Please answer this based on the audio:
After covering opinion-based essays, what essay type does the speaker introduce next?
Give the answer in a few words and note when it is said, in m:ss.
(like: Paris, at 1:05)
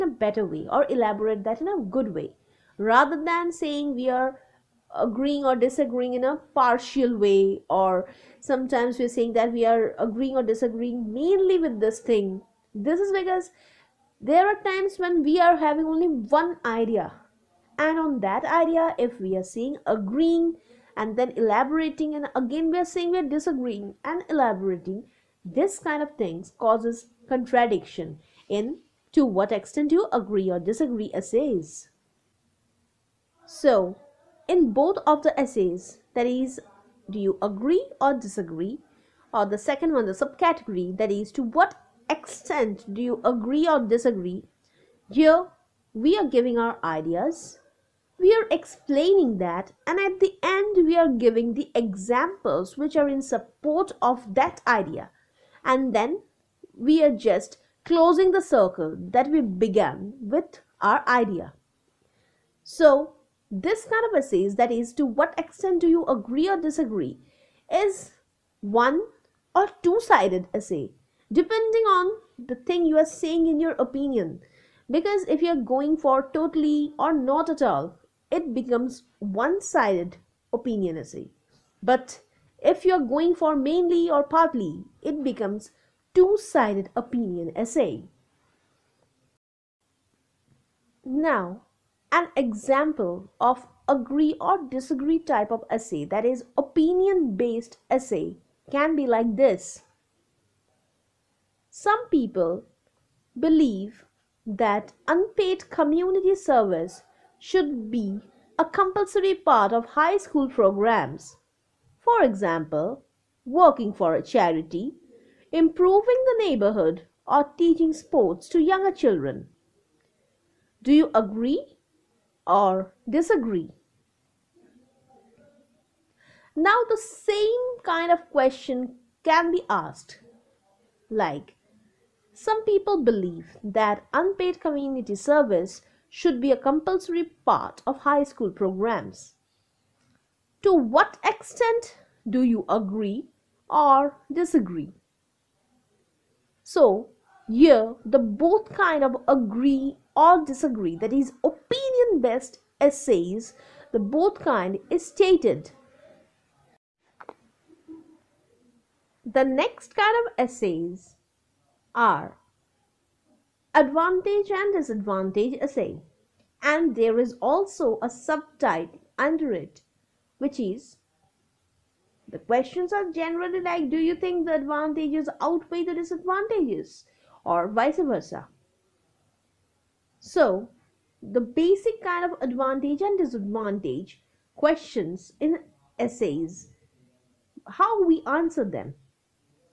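advantage and disadvantage essay, at 2:43.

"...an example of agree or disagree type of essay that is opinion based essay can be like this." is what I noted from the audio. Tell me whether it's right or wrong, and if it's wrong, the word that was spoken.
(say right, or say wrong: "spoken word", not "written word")
right.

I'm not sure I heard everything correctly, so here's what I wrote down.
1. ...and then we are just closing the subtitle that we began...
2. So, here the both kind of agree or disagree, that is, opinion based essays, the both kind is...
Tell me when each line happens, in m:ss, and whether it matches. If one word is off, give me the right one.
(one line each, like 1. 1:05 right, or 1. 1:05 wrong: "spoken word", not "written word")
1. 0:55 wrong: "circle", not "subtitle"
2. 2:26 right.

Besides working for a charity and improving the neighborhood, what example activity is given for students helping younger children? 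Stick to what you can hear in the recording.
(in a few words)
teaching sports.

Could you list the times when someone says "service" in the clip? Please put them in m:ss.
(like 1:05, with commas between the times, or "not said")
1:46, 2:15.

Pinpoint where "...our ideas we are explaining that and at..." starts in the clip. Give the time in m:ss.
0:46.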